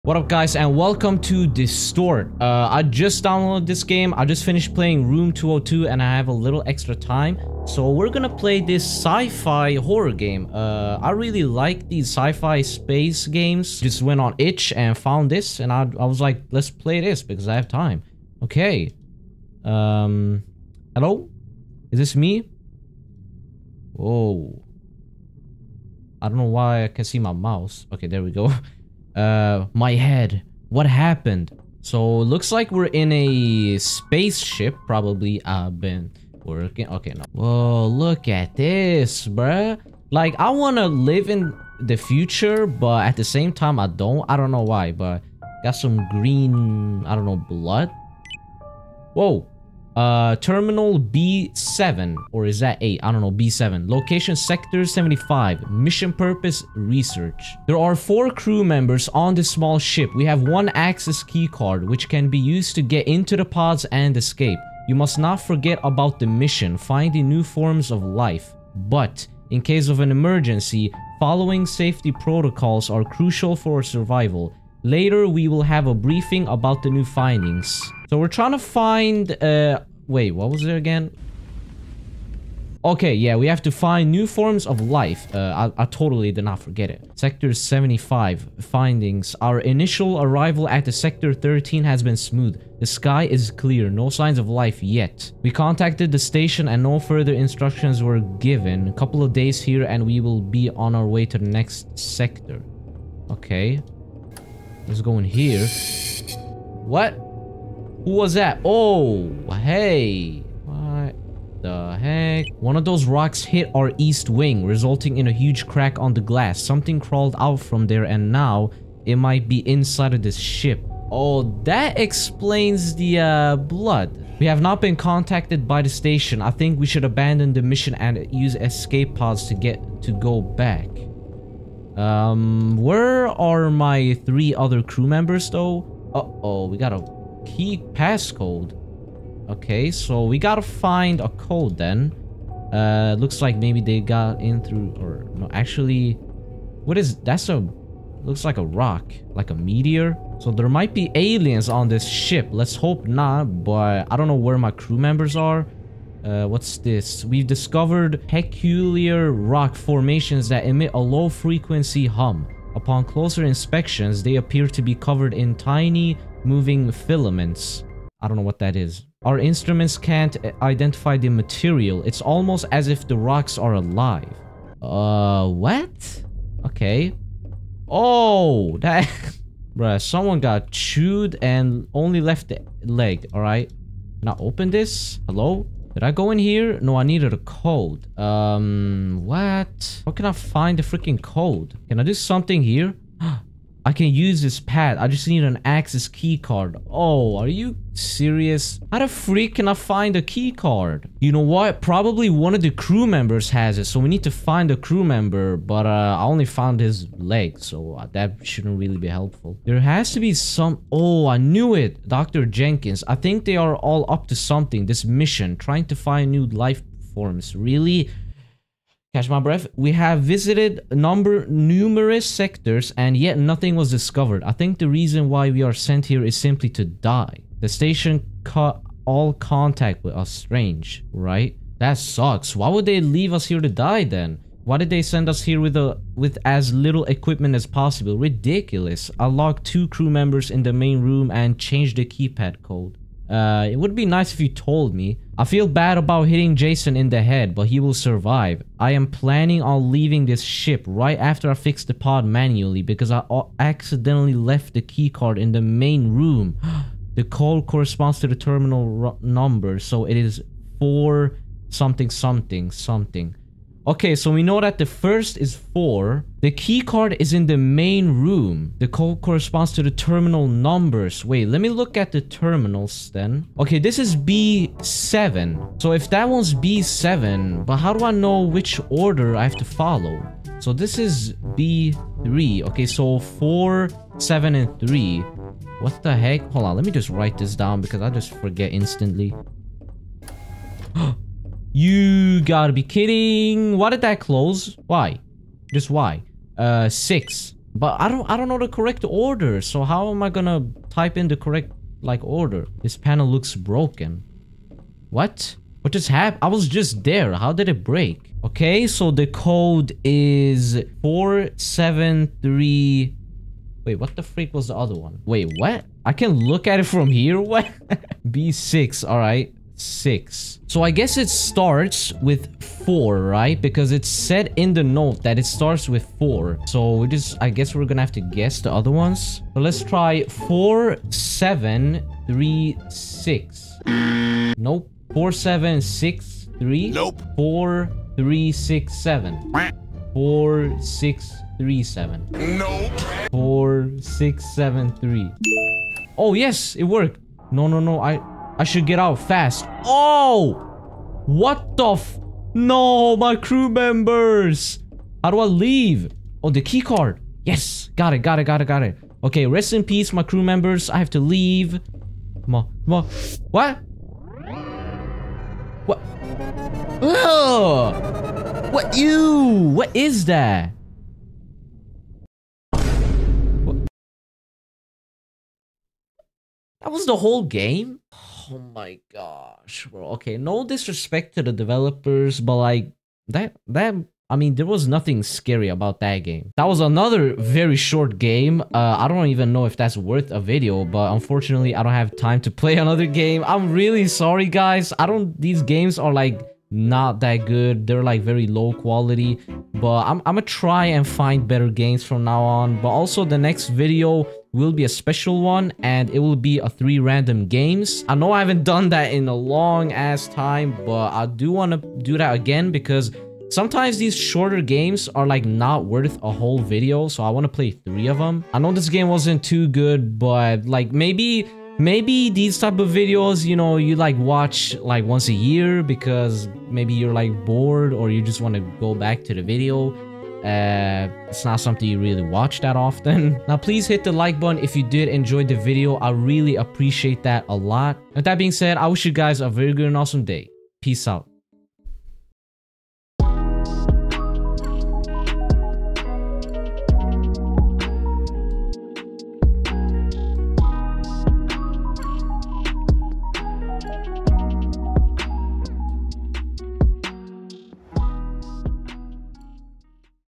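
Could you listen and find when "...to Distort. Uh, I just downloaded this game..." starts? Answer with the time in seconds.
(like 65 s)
1 s.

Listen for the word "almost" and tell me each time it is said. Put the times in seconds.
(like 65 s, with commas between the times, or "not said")
172 s.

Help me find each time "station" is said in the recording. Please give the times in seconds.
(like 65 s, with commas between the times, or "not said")
96 s, 125 s, 227 s.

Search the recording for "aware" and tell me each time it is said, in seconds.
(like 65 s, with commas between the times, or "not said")
not said.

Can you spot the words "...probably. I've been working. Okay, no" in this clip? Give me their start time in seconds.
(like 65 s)
34 s.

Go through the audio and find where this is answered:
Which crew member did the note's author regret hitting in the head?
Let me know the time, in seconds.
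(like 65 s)
246 s.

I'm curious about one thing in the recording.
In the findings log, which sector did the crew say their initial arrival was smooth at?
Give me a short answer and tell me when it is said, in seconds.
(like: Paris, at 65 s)
Sector 13, at 90 s.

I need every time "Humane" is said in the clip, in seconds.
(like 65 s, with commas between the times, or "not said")
not said.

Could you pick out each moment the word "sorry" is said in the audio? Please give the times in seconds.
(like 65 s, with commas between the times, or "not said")
394 s.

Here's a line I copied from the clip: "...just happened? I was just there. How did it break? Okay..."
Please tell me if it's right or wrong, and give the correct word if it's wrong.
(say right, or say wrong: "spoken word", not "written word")
right.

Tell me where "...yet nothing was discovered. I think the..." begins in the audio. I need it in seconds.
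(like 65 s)
223 s.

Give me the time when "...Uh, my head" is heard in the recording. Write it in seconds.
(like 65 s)
29 s.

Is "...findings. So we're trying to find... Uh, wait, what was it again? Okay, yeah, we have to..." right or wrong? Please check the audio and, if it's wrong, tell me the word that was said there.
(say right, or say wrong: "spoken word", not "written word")
right.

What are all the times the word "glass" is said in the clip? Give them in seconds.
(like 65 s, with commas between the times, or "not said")
116 s.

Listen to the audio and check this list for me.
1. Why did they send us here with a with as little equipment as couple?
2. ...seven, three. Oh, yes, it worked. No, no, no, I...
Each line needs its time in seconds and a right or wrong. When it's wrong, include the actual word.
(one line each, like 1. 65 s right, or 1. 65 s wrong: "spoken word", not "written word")
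1. 234 s wrong: "possible", not "couple"
2. 344 s right.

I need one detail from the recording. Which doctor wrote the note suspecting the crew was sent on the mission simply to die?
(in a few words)
Dr. Jenkins.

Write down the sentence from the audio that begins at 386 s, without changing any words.
That was another very short game.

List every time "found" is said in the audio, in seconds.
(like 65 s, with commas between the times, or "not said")
14 s, 206 s.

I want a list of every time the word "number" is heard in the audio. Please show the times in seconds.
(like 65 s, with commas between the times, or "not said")
220 s, 259 s, 270 s.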